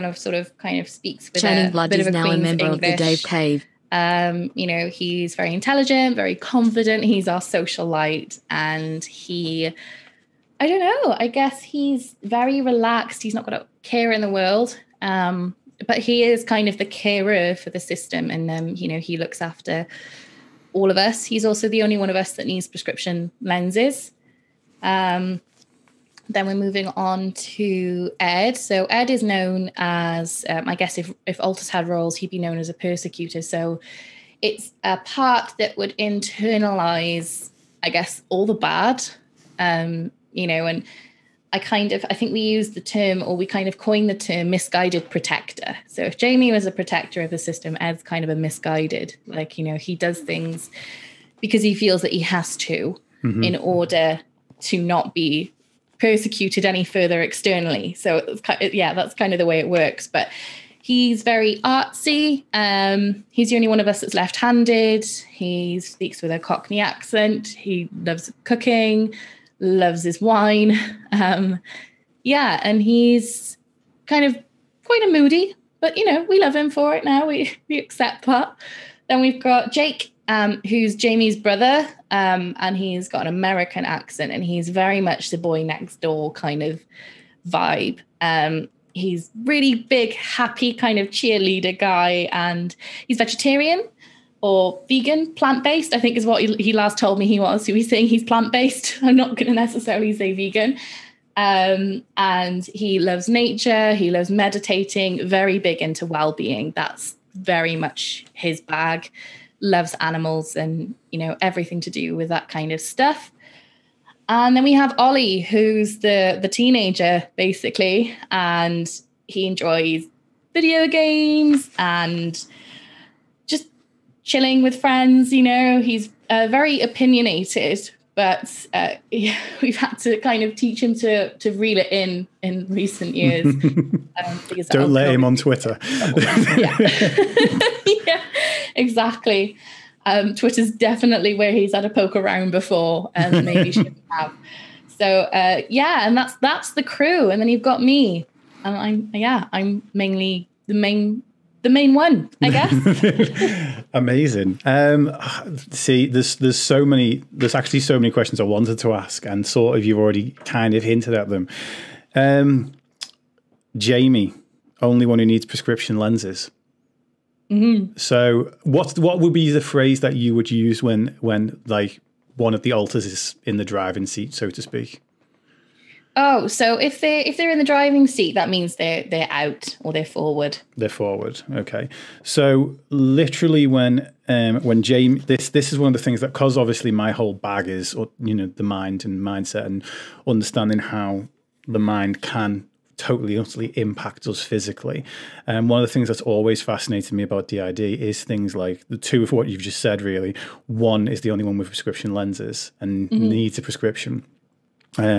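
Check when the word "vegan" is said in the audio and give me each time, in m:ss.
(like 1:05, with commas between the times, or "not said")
1:34, 1:40.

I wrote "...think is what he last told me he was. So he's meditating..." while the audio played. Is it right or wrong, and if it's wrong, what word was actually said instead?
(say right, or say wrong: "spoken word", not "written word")
wrong: "saying", not "meditating".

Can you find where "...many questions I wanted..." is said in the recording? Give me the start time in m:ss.
2:37.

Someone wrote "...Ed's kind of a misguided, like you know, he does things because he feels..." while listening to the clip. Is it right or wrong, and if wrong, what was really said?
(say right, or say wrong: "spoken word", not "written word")
right.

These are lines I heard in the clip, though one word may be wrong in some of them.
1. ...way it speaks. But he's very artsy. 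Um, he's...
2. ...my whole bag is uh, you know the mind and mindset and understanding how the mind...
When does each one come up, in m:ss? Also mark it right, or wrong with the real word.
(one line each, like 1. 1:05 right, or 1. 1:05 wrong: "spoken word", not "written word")
1. 0:59 wrong: "works", not "speaks"
2. 3:06 right.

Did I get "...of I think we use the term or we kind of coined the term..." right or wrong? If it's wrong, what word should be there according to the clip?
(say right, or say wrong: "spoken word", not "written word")
right.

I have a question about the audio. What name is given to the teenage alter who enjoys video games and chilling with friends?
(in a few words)
Ollie.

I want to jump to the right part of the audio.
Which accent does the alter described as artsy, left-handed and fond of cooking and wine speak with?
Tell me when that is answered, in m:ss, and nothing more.
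1:06.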